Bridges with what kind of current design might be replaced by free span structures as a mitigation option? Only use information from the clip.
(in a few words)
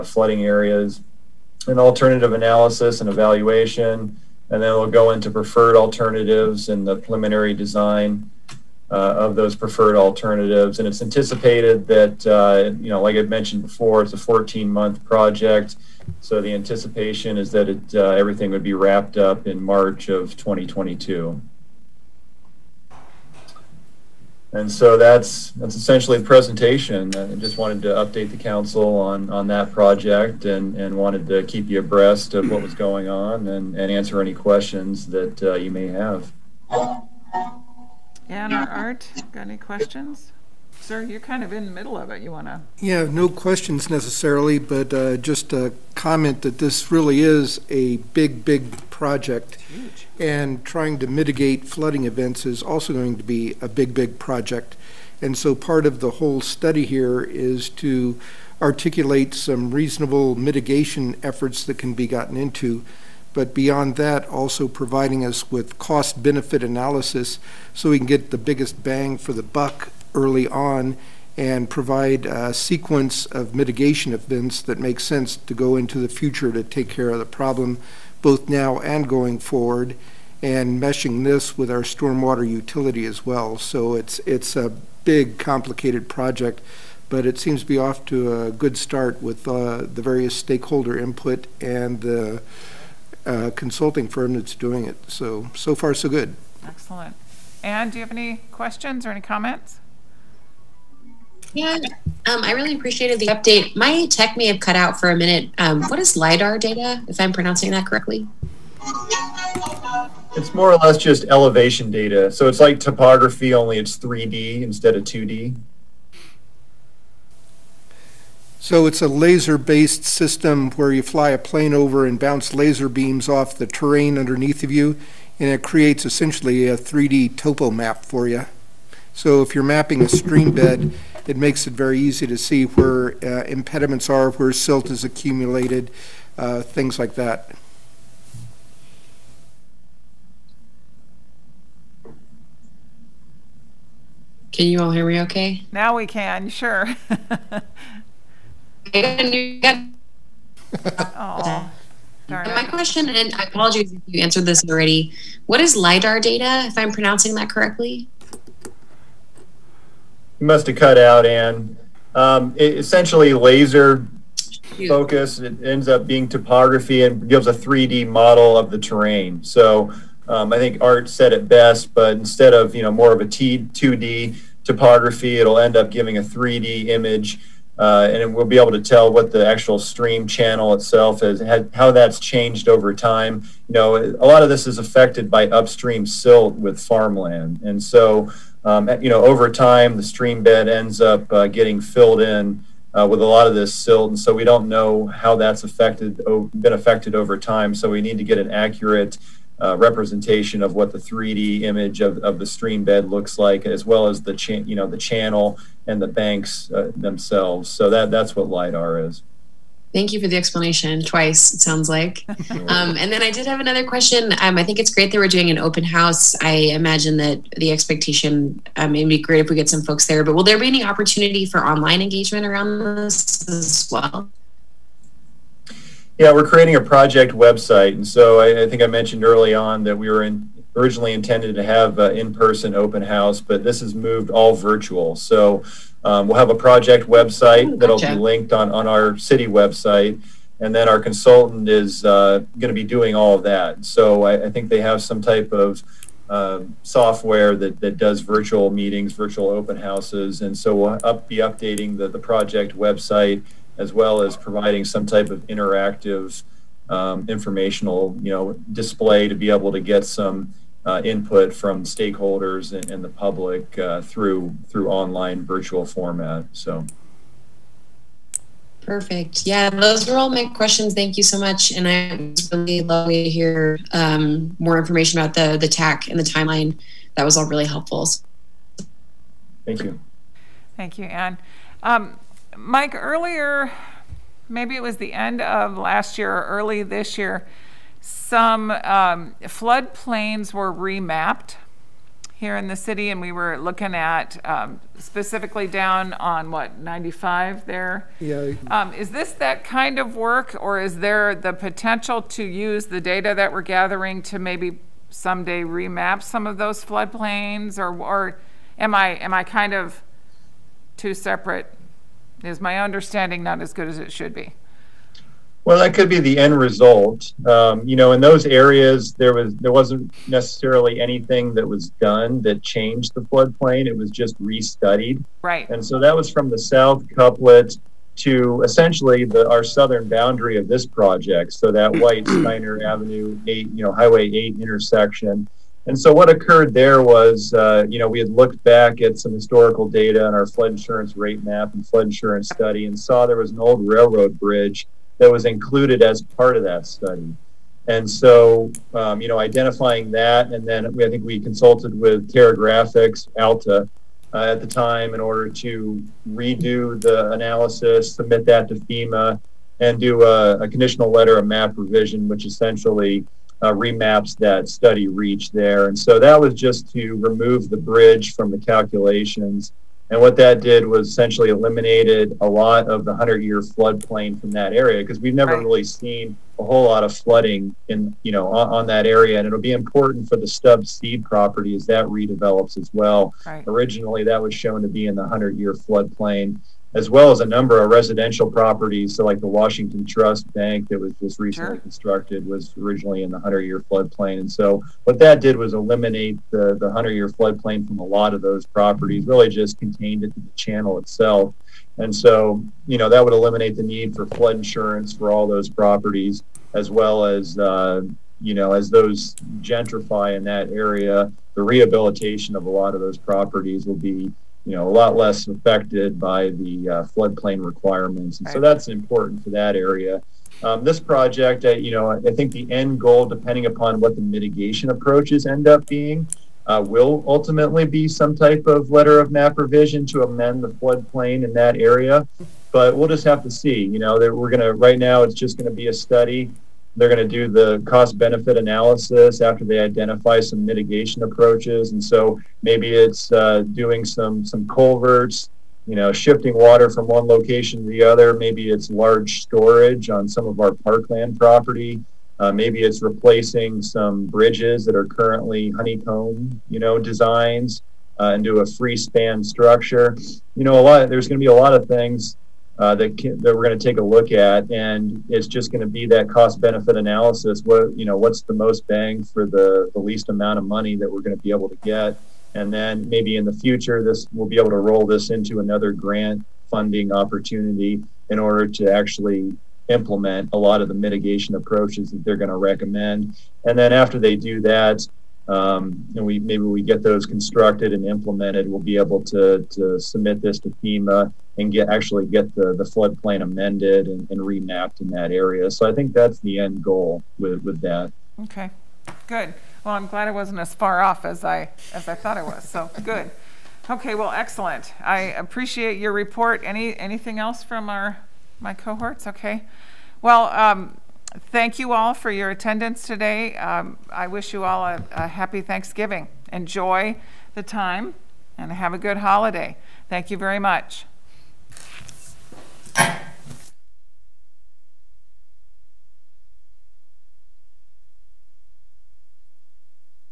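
honeycomb.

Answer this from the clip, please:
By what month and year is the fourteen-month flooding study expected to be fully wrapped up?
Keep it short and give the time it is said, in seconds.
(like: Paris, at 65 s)
March 2022, at 19 s.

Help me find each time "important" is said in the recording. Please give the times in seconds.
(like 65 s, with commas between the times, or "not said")
379 s, 418 s.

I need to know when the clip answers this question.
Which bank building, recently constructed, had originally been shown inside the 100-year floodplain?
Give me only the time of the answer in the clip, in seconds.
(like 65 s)
389 s.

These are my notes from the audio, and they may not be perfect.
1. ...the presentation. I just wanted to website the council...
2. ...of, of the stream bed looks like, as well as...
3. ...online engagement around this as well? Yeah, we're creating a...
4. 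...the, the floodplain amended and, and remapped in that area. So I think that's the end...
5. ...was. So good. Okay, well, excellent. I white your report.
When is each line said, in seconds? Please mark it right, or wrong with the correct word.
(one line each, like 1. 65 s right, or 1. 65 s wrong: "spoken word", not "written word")
1. 26 s wrong: "update", not "website"
2. 202 s right
3. 221 s right
4. 492 s right
5. 502 s wrong: "appreciate", not "white".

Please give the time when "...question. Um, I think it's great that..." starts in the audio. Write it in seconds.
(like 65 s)
213 s.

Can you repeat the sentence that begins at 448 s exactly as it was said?
Maybe it's large storage on some of our parkland property.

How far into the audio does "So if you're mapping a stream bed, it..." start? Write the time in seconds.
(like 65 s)
129 s.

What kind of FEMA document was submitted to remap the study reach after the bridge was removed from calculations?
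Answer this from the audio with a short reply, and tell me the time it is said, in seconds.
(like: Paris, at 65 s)
conditional letter of map revision, at 360 s.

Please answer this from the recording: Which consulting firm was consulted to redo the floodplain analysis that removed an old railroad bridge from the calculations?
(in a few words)
Terragraphics.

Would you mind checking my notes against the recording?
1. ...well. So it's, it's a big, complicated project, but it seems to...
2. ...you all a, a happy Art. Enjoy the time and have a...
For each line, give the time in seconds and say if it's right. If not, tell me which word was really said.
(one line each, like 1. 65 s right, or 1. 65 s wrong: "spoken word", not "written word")
1. 83 s right
2. 514 s wrong: "Thanksgiving", not "Art".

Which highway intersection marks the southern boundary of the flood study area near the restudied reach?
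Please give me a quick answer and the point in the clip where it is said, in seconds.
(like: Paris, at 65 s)
Highway 8, at 333 s.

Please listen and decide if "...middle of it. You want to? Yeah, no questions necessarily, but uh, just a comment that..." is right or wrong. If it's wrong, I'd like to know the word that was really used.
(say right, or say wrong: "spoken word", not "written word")
right.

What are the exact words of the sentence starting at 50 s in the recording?
And trying to mitigate flooding events is also going to be a big, big project.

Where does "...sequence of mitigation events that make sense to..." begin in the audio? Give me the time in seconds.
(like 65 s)
72 s.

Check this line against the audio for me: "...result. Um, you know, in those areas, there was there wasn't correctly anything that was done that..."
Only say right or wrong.
wrong.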